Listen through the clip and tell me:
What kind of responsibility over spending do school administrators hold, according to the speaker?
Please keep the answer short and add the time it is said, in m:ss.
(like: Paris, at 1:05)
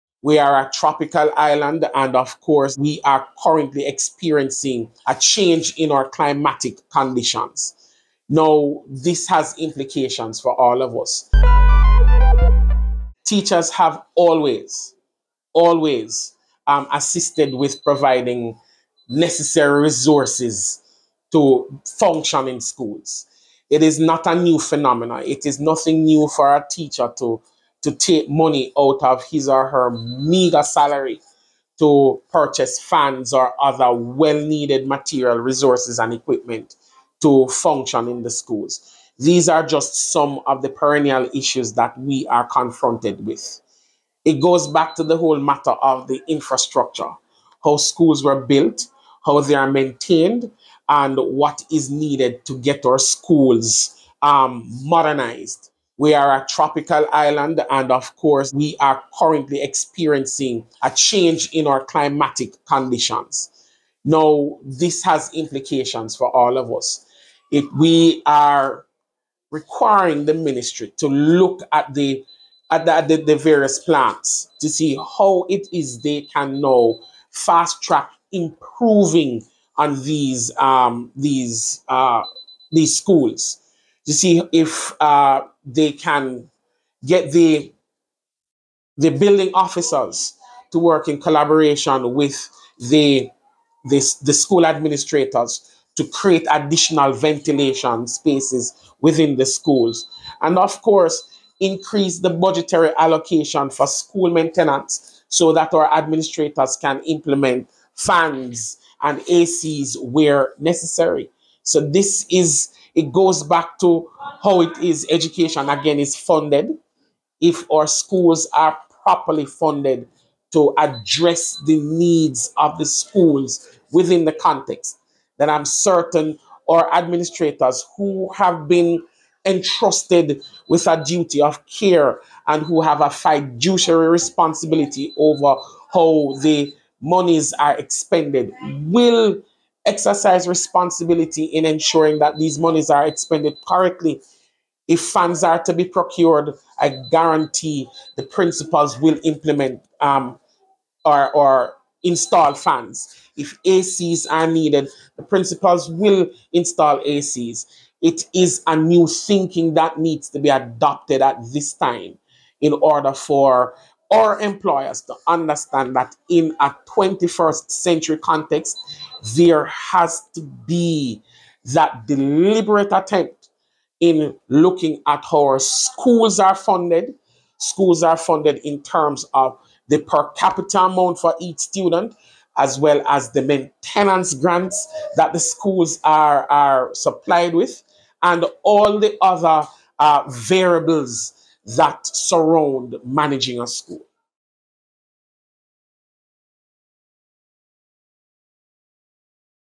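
fiduciary, at 2:13.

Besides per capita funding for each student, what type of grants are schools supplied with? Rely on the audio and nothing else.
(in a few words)
maintenance grants.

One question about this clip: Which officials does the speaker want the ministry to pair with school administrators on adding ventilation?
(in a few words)
building officers.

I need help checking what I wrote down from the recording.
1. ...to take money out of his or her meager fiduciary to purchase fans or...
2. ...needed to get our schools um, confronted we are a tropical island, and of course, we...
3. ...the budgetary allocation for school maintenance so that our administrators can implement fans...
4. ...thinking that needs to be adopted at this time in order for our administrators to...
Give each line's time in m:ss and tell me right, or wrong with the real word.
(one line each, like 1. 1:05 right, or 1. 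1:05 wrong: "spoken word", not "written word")
1. 0:27 wrong: "salary", not "fiduciary"
2. 0:51 wrong: "modernized", not "confronted"
3. 1:42 right
4. 2:39 wrong: "employers", not "administrators".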